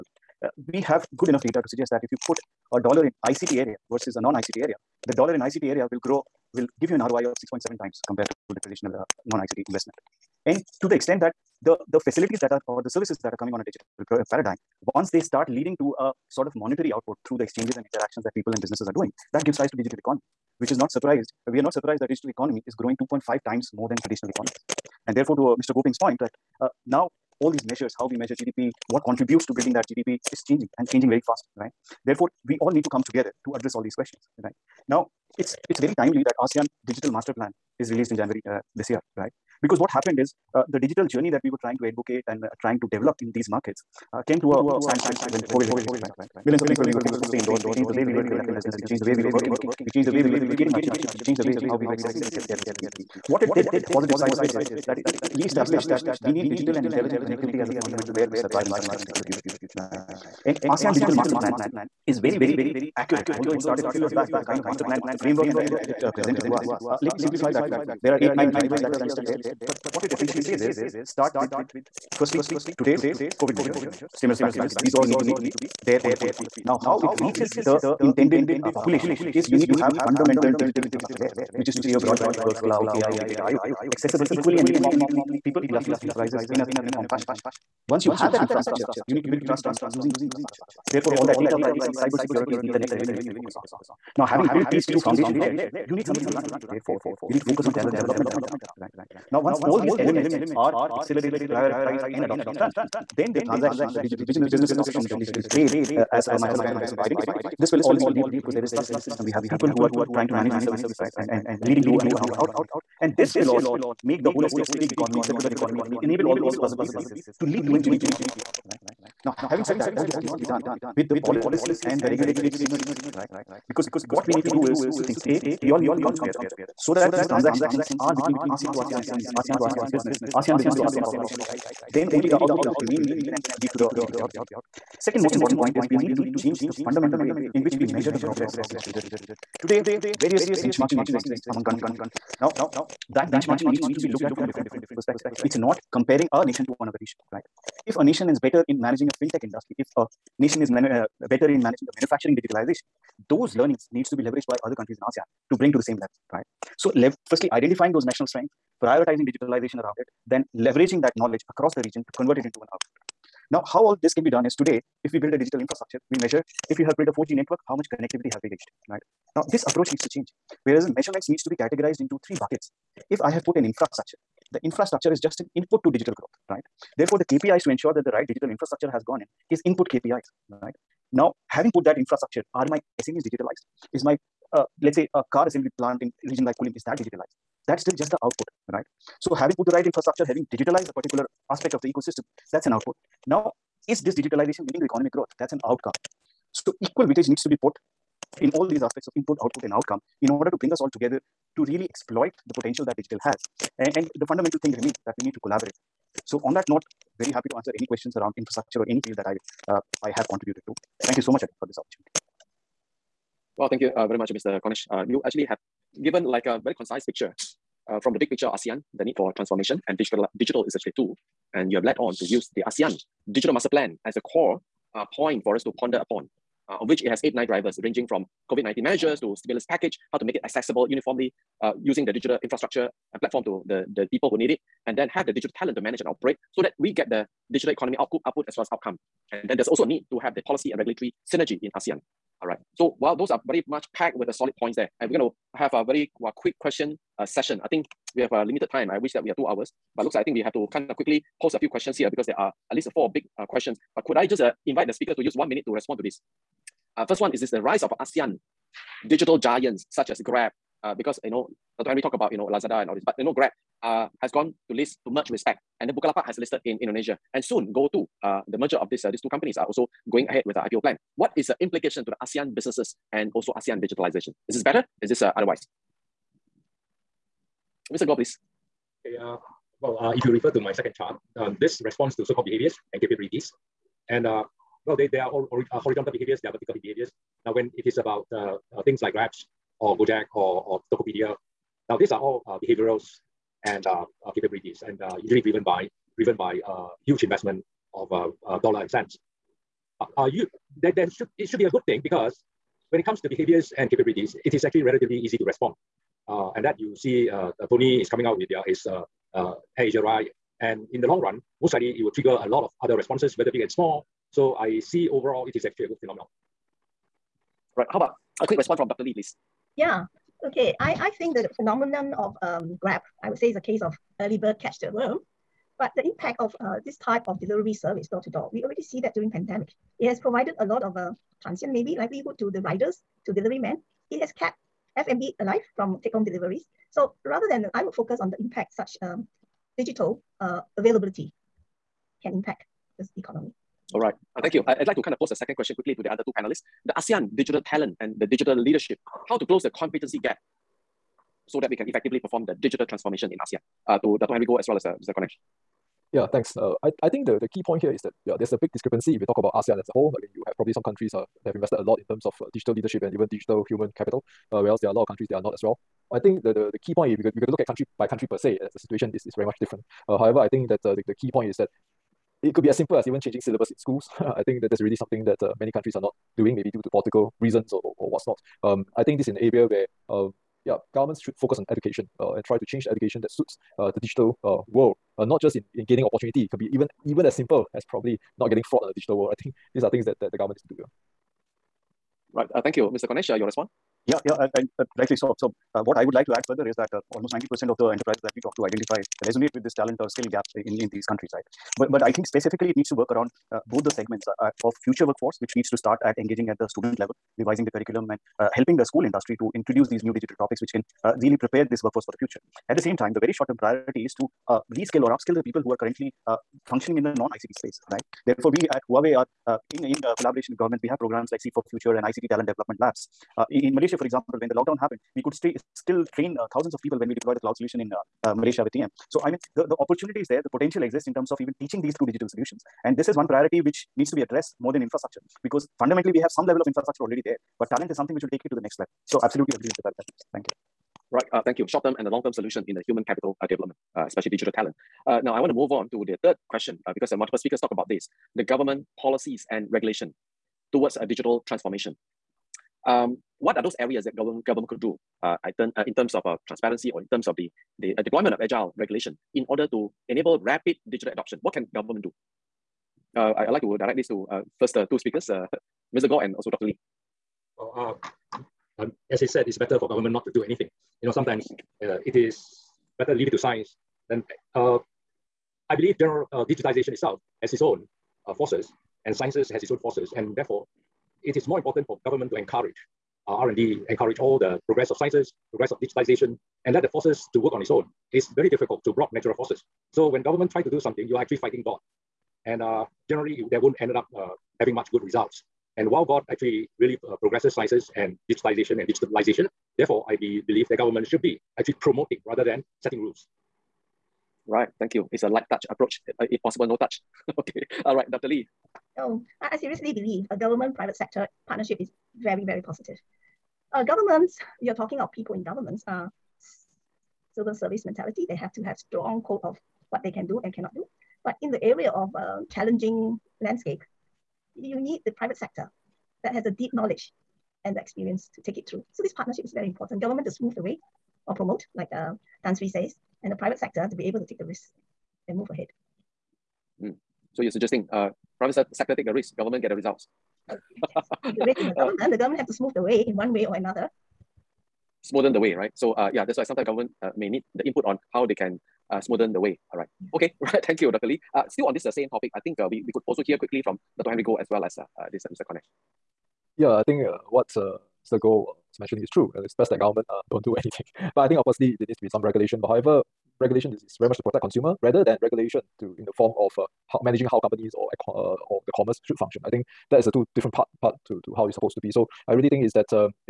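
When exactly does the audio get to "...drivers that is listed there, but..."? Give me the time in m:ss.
1:08.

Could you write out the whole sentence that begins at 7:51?
You know, sometimes uh, it is better leave it to science.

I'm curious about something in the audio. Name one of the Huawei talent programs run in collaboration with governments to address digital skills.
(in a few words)
Seed for Future.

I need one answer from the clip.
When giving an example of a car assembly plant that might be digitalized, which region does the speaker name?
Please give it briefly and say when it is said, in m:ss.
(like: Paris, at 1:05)
Kulim, at 3:06.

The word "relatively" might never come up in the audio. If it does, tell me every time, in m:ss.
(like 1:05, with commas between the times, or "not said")
5:04.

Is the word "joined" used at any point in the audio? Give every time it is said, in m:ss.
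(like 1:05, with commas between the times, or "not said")
not said.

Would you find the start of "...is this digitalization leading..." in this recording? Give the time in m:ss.
3:13.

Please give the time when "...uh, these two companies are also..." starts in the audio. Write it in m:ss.
4:29.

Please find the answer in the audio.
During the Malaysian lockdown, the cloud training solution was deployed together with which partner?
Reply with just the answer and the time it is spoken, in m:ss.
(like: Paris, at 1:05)
TM, at 7:08.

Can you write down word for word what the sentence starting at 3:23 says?
And, and the fundamental thing remains that we need to collaborate.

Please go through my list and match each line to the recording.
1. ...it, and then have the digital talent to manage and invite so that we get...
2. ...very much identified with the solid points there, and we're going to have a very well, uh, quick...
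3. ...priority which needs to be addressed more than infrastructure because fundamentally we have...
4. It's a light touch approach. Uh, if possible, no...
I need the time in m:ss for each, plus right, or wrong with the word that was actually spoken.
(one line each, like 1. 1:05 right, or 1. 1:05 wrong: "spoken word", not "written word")
1. 3:54 wrong: "operate", not "invite"
2. 4:03 wrong: "packed", not "identified"
3. 7:13 right
4. 8:25 right.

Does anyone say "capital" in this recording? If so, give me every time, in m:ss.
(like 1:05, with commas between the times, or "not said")
6:03, 7:23.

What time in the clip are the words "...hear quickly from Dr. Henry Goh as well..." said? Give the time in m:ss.
9:13.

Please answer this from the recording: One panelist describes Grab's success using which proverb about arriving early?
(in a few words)
early bird catch the worm.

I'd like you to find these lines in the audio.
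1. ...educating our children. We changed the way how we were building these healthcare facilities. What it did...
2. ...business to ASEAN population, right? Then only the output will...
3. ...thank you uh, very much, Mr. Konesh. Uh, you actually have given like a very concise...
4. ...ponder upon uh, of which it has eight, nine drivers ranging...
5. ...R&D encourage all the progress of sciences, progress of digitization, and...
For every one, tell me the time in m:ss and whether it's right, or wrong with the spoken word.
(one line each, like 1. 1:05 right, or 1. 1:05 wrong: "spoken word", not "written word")
1. 0:50 wrong: "accessing", not "building"
2. 2:10 right
3. 3:33 right
4. 3:45 right
5. 8:03 right.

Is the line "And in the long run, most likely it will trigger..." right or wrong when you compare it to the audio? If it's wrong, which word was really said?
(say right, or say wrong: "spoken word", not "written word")
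right.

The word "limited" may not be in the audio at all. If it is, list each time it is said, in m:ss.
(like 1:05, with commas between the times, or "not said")
4:08.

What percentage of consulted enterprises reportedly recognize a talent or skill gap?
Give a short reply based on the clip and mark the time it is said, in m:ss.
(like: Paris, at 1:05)
90%, at 6:37.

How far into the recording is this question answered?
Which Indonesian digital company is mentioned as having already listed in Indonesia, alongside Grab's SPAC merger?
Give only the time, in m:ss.
4:25.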